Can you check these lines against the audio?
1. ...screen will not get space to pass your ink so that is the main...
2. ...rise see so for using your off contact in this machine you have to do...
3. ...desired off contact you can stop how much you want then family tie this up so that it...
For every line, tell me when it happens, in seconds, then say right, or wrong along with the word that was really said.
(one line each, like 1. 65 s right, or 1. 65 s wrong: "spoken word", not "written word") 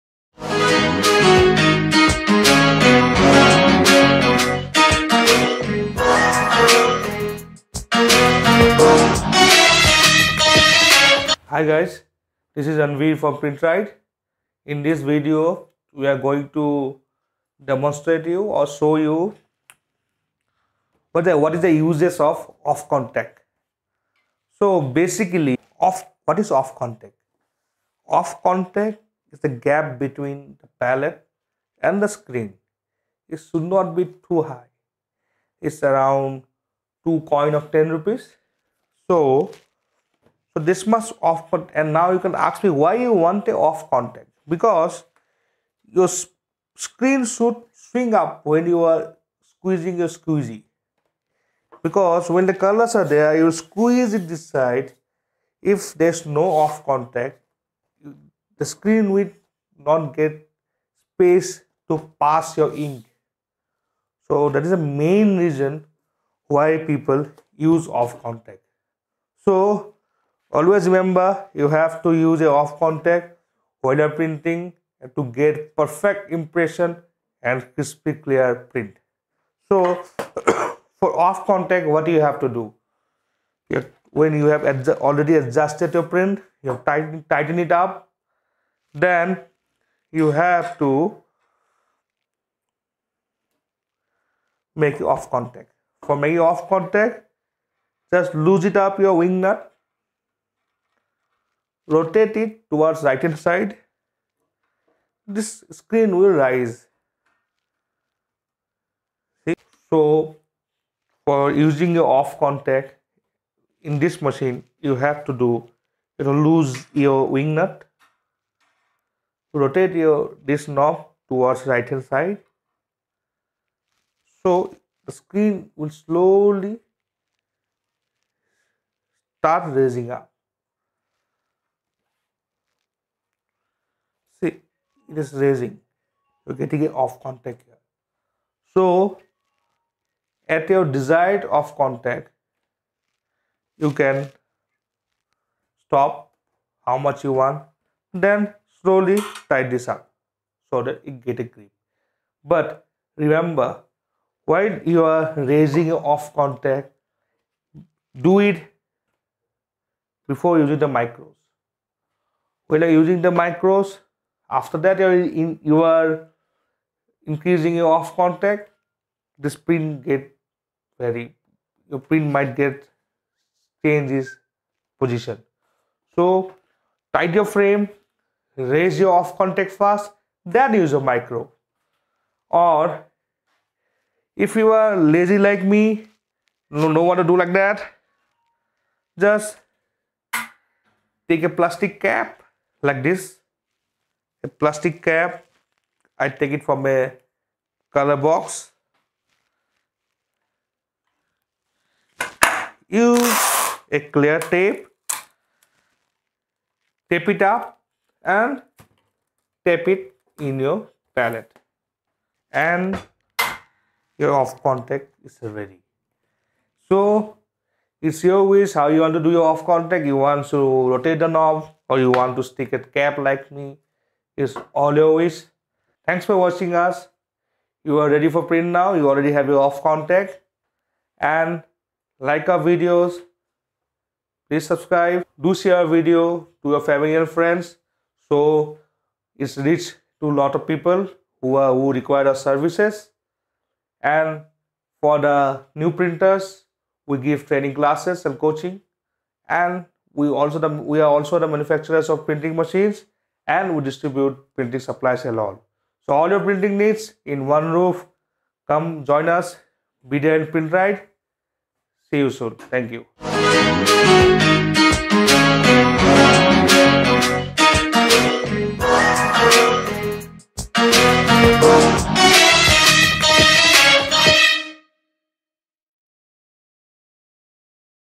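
1. 58 s right
2. 106 s right
3. 140 s wrong: "slowly", not "family".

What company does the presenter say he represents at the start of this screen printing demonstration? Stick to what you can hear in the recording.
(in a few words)
Printride.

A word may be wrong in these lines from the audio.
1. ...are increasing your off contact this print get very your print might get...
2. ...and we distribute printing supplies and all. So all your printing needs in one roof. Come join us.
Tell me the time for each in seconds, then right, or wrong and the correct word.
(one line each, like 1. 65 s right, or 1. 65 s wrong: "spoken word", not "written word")
1. 165 s right
2. 253 s right.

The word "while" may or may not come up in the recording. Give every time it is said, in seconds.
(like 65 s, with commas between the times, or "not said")
73 s, 154 s.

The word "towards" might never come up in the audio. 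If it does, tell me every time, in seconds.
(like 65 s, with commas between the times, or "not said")
102 s, 121 s.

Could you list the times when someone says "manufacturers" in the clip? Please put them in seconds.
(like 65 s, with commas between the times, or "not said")
251 s.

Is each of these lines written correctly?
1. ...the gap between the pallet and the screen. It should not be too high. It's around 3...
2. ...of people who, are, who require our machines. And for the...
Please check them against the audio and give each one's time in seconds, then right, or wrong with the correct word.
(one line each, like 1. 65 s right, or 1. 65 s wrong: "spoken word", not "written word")
1. 29 s wrong: "2", not "3"
2. 240 s wrong: "services", not "machines".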